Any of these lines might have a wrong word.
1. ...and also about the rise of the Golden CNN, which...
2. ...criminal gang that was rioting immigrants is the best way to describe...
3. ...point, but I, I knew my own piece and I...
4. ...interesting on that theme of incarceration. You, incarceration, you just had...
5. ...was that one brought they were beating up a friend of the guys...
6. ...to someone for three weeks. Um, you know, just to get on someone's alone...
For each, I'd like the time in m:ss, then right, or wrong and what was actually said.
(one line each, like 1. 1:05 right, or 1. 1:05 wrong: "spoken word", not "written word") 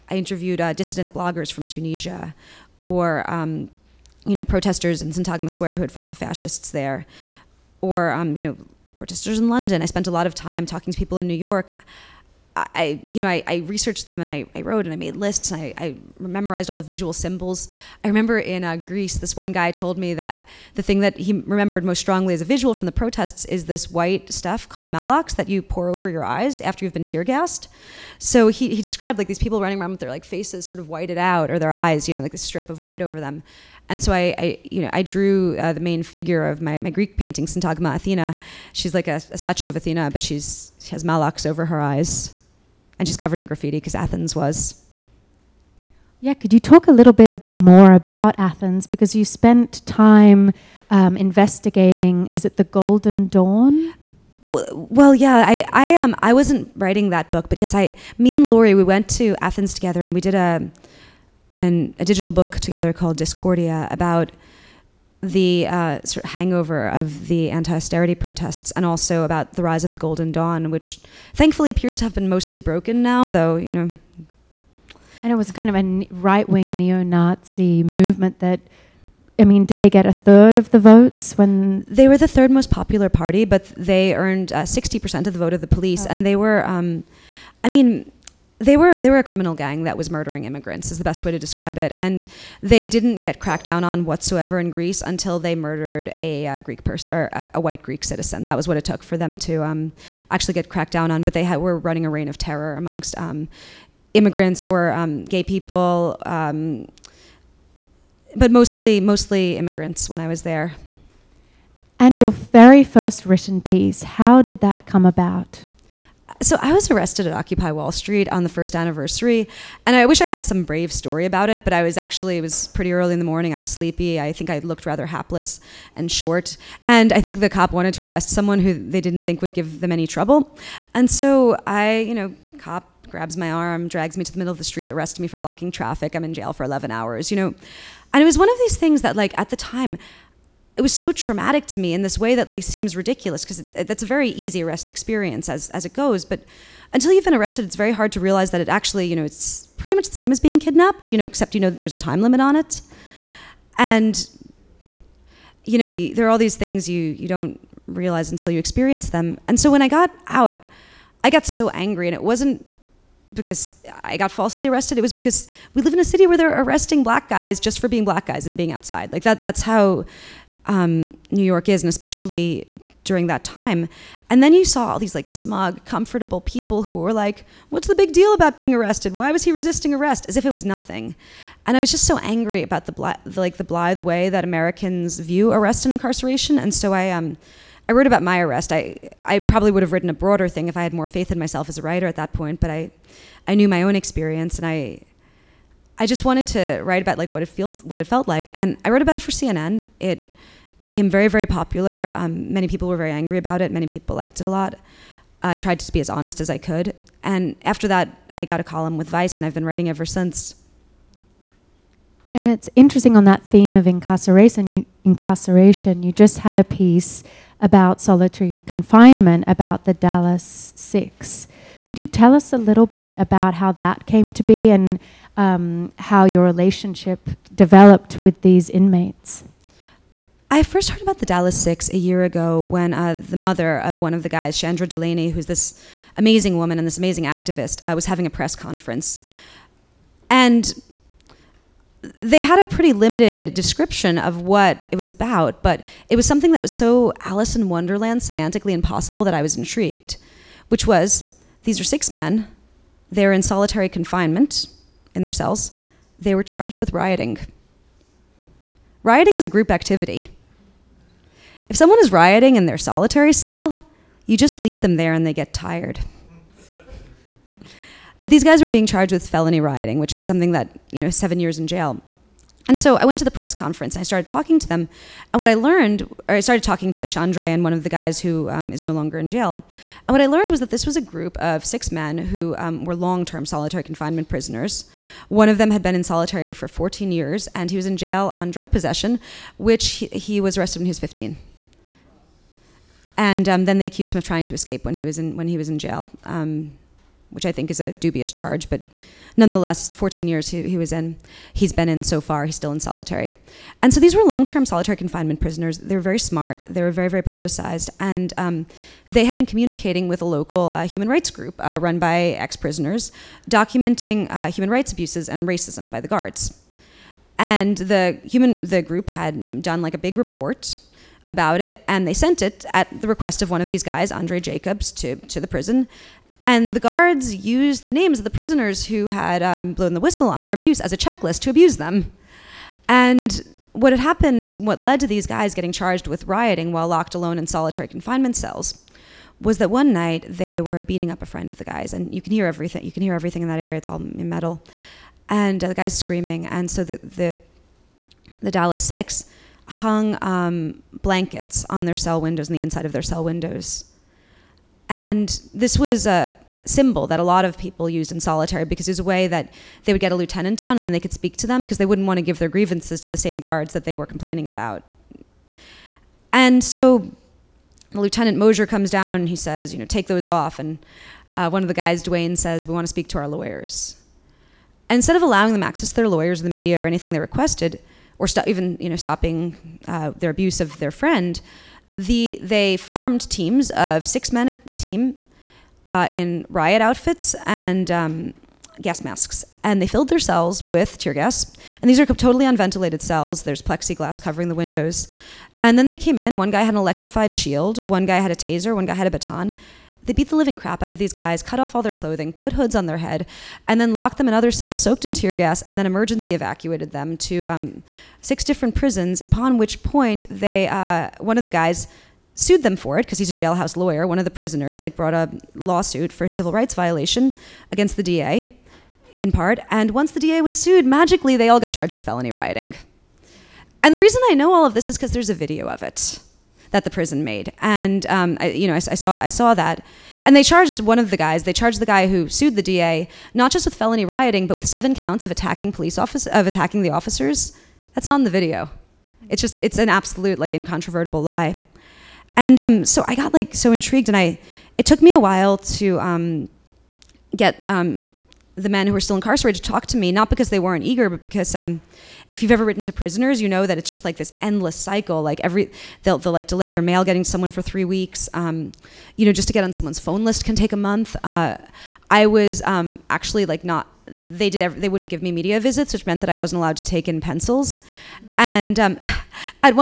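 1. 1:08 wrong: "Dawn", not "CNN"
2. 1:29 wrong: "murdering", not "rioting"
3. 3:12 wrong: "experience", not "piece"
4. 3:32 right
5. 5:39 wrong: "night", not "brought"
6. 7:37 wrong: "phone", not "alone".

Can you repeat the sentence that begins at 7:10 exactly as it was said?
And they charged one of the guys.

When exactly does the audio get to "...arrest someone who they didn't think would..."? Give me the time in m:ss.
2:08.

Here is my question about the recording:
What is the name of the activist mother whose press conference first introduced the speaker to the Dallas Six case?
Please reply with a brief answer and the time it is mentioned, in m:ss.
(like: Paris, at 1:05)
Shandre Delaney, at 3:54.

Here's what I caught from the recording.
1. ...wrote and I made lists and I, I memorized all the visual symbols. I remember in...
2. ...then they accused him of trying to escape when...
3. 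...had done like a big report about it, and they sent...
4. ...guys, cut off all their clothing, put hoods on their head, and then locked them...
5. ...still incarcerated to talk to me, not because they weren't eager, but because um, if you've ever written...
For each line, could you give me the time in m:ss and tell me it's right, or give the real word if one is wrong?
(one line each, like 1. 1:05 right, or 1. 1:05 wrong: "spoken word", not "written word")
1. 0:14 right
2. 4:53 right
3. 5:19 right
4. 6:41 right
5. 7:28 right.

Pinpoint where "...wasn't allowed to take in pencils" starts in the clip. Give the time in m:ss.
7:46.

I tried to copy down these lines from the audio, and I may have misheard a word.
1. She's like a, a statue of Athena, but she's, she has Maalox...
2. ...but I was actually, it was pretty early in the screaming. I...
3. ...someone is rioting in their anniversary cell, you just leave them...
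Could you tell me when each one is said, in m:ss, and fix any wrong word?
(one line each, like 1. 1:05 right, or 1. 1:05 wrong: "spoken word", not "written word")
1. 0:38 right
2. 2:01 wrong: "morning", not "screaming"
3. 4:21 wrong: "solitary", not "anniversary".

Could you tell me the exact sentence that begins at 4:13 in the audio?
They're in solitary confinement in their cells.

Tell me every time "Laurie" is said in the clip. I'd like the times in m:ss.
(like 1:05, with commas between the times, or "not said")
0:58.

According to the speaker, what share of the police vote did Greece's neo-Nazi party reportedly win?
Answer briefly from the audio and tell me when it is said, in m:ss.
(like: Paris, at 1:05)
60 percent, at 1:24.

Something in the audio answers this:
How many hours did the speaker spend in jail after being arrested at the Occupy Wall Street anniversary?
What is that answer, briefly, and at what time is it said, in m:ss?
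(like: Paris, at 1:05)
11 hours, at 2:16.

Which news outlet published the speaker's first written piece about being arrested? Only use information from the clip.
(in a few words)
CNN.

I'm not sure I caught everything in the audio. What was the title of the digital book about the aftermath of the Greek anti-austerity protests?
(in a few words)
Discordia.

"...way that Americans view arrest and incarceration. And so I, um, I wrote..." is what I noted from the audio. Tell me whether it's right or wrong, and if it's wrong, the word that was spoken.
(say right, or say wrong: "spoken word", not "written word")
right.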